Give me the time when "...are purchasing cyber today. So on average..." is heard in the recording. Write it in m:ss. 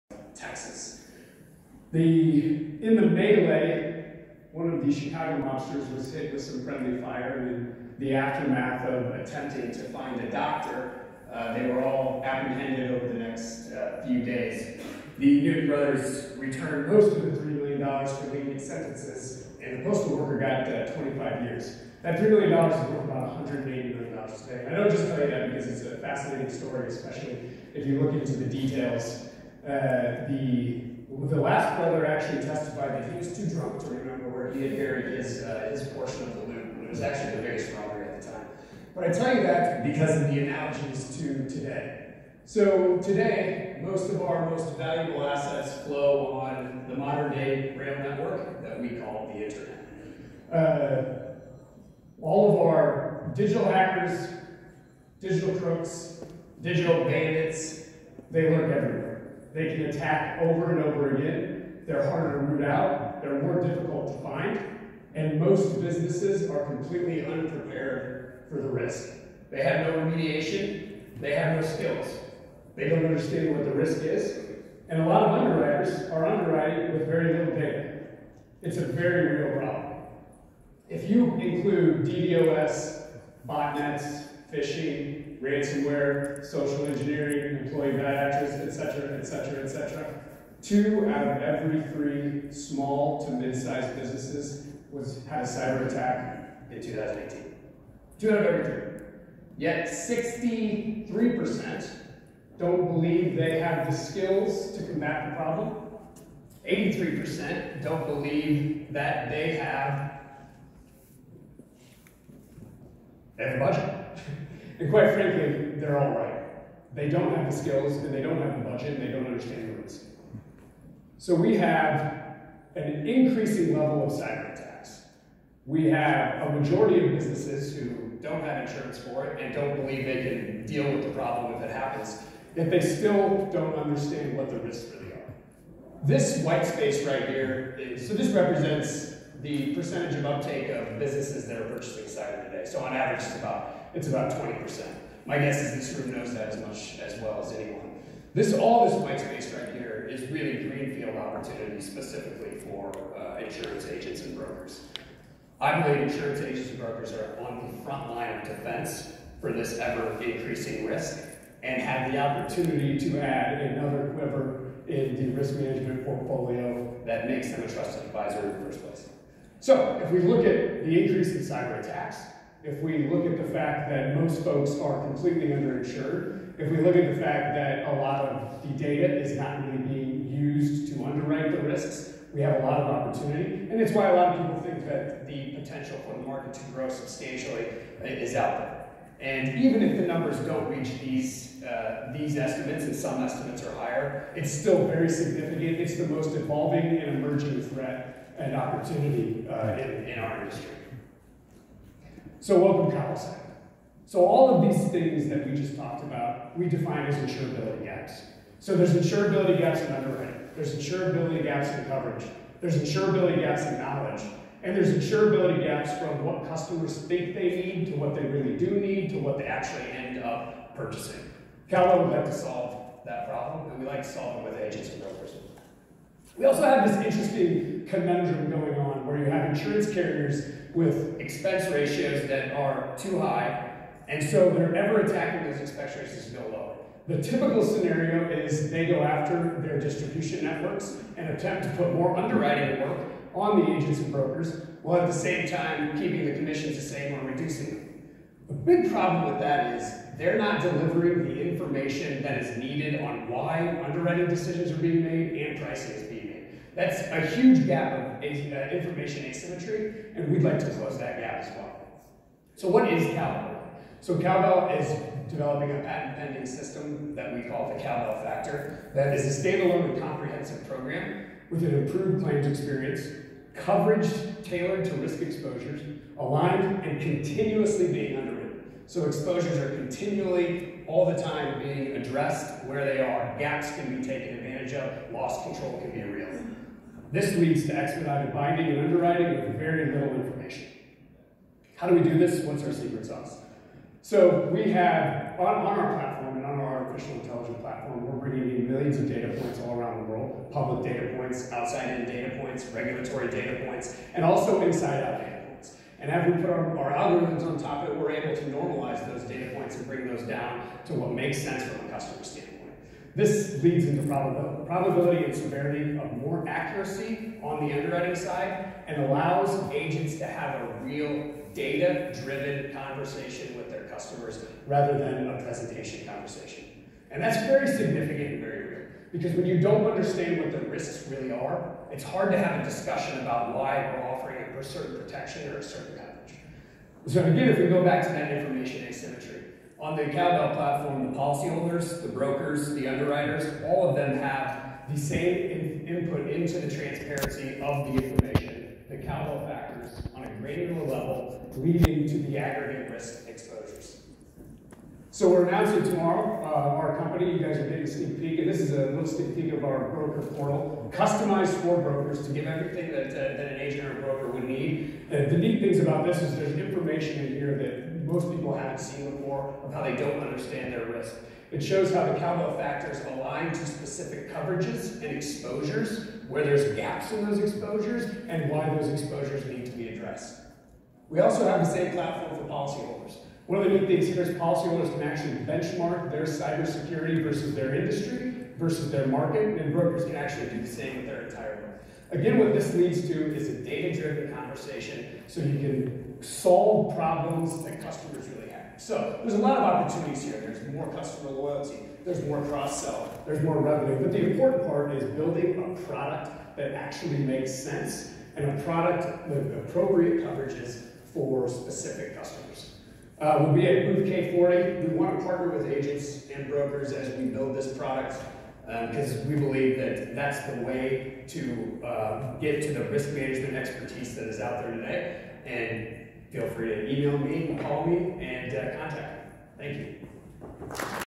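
2:21.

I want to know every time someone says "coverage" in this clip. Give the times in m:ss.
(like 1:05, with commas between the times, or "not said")
3:31, 4:33, 5:35, 6:14, 6:50.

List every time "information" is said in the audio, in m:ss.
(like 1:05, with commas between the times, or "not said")
4:11, 4:18, 4:50, 5:38, 5:48, 6:06.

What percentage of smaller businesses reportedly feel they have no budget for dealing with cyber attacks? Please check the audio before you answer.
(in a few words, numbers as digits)
83%.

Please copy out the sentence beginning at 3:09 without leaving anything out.
And even if the numbers don't reach these, uh, these estimates, and some estimates are higher, it's still very significant.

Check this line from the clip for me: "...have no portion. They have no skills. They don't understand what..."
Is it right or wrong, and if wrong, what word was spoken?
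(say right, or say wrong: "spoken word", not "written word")
wrong: "remediation", not "portion".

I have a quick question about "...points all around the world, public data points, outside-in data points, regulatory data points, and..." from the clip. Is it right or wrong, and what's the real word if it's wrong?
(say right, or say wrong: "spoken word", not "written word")
right.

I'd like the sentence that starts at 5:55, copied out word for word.
So we're announcing tomorrow uh, our company.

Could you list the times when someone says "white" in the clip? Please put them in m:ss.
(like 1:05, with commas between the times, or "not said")
2:16, 2:28.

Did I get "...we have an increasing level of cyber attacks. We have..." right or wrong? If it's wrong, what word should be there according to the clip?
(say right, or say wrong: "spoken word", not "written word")
right.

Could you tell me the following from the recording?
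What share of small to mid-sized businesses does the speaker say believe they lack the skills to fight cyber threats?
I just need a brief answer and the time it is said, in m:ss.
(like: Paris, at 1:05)
63%, at 1:39.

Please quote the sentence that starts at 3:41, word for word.
Cowbell would like to solve that problem, and we like to solve it with agents and brokers.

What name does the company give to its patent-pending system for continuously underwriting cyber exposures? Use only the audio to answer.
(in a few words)
cowbell factor.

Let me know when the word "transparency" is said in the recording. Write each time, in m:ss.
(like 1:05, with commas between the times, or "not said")
5:46.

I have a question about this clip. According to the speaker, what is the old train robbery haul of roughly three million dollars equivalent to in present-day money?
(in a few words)
$180 million.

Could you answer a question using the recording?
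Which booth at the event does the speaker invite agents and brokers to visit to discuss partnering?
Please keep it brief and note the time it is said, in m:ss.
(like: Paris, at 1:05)
K40, at 6:53.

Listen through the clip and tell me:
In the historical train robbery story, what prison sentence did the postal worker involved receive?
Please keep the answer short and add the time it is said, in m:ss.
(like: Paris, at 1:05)
25 years, at 0:20.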